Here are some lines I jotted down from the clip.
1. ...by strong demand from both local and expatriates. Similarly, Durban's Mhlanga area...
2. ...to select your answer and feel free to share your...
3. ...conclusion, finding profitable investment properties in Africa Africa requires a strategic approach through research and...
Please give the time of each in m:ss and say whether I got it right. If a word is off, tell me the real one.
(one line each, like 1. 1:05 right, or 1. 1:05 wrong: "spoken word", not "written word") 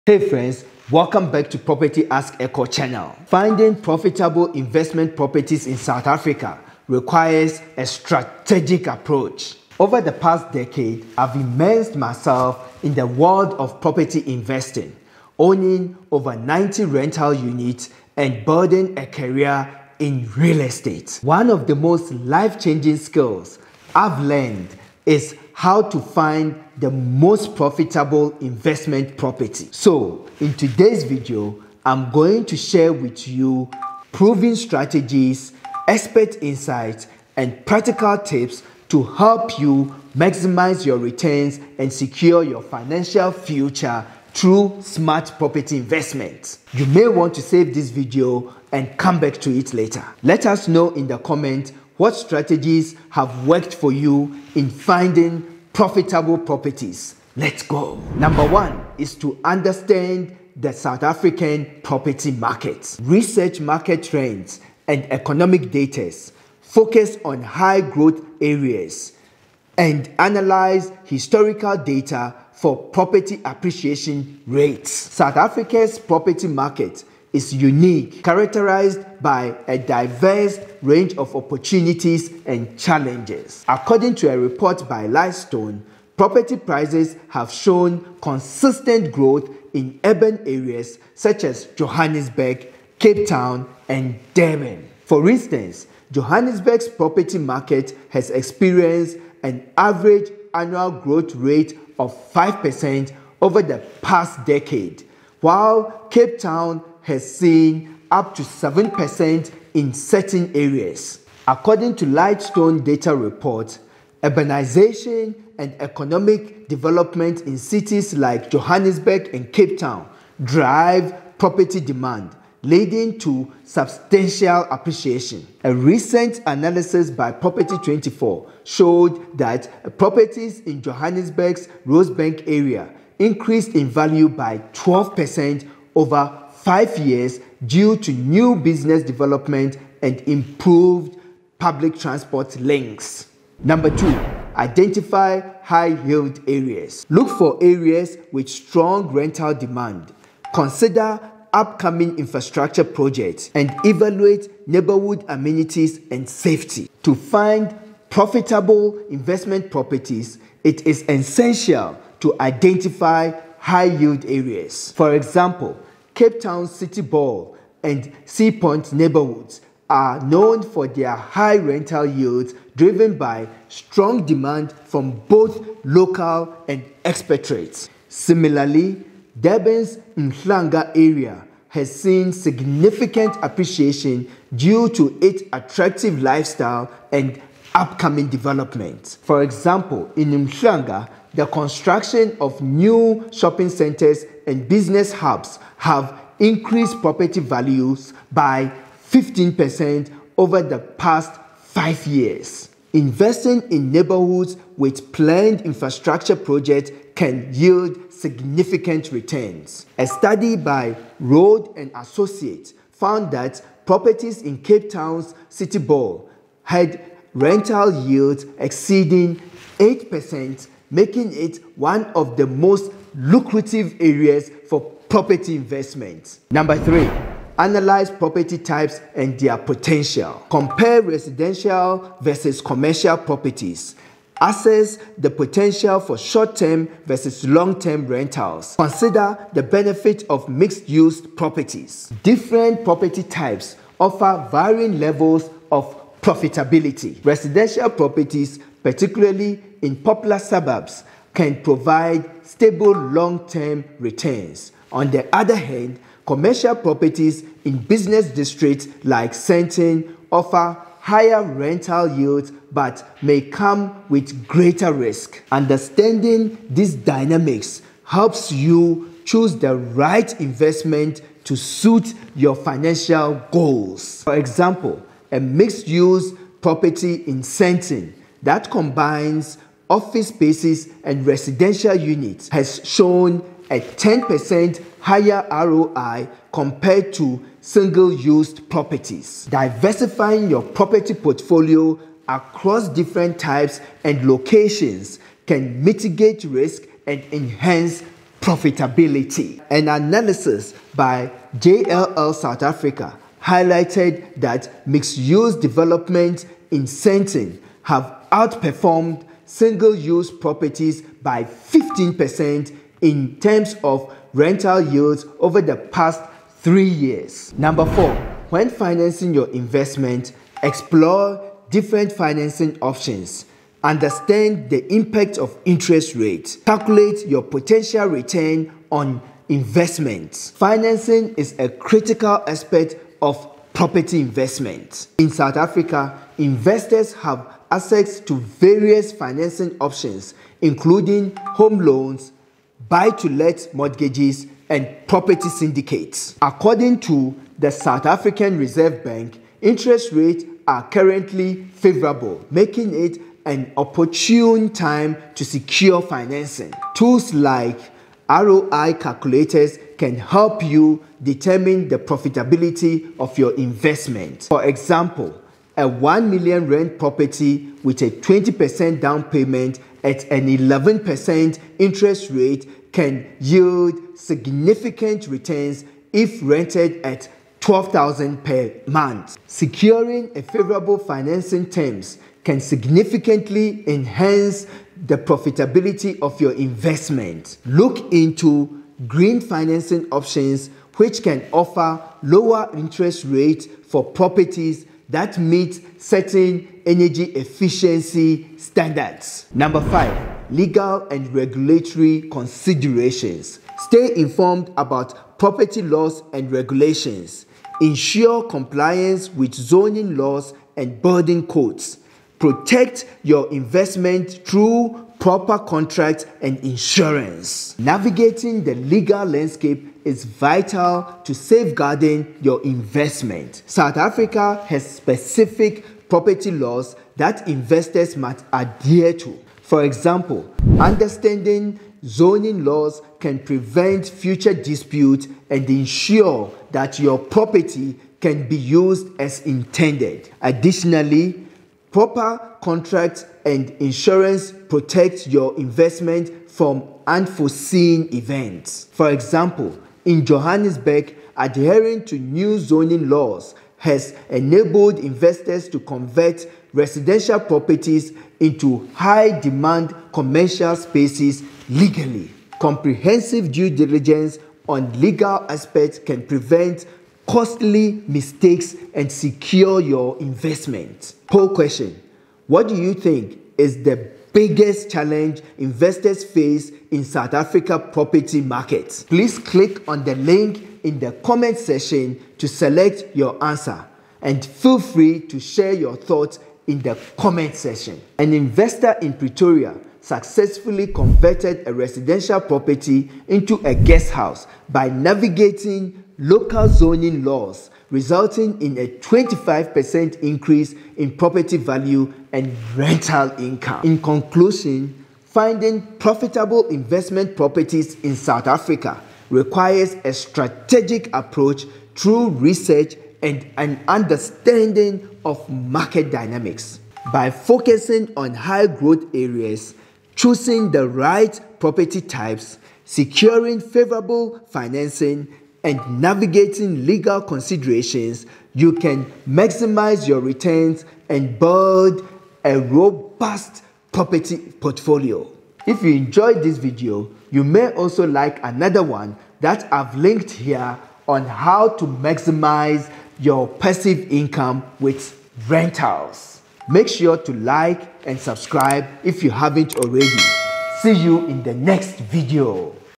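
1. 2:53 right
2. 8:02 right
3. 8:24 wrong: "South", not "Africa".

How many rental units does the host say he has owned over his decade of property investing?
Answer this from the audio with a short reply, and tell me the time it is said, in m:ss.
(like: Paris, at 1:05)
over 90, at 0:16.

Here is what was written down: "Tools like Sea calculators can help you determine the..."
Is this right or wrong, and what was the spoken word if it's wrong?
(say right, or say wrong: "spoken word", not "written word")
wrong: "ROI", not "Sea".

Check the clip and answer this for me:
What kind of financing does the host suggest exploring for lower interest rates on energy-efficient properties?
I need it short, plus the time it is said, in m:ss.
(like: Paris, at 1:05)
green financing, at 6:29.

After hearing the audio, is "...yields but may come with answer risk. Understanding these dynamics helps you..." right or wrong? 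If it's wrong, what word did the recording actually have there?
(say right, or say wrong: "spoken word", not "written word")
wrong: "greater", not "answer".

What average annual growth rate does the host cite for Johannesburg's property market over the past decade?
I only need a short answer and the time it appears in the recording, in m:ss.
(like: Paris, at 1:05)
5%, at 1:42.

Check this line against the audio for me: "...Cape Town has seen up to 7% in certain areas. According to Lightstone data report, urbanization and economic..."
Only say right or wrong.
right.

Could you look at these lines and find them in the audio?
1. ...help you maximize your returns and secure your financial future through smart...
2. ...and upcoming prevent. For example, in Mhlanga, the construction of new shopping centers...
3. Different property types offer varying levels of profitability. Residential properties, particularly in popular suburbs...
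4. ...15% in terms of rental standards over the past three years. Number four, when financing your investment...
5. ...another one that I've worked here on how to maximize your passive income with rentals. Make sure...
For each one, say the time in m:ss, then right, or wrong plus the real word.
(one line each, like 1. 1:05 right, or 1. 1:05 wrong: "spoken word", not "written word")
1. 0:39 right
2. 3:07 wrong: "development", not "prevent"
3. 4:02 right
4. 5:11 wrong: "yields", not "standards"
5. 8:58 wrong: "linked", not "worked".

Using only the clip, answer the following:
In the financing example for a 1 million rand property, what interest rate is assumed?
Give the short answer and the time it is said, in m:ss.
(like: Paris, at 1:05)
11%, at 6:10.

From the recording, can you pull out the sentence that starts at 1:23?
According to a report by Lightstone, property prices have shown consistent growth in urban areas such as Johannesburg, Cape Town, and Durban.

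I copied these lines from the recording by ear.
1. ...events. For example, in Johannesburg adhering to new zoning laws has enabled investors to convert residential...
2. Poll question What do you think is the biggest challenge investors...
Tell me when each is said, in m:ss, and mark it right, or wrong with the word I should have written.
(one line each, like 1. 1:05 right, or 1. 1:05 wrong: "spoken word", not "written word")
1. 7:28 right
2. 7:51 right.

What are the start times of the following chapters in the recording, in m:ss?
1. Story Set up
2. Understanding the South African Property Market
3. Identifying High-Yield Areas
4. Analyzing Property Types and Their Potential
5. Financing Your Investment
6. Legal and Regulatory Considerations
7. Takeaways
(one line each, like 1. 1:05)
1. 0:28
2. 0:58
3. 2:22
4. 3:47
5. 5:17
6. 6:39
7. 8:23.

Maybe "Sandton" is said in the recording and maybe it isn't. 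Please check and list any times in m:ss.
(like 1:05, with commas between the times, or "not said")
4:19, 4:37, 5:06.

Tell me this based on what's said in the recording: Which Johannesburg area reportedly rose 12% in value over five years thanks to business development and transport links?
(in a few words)
Rosebank.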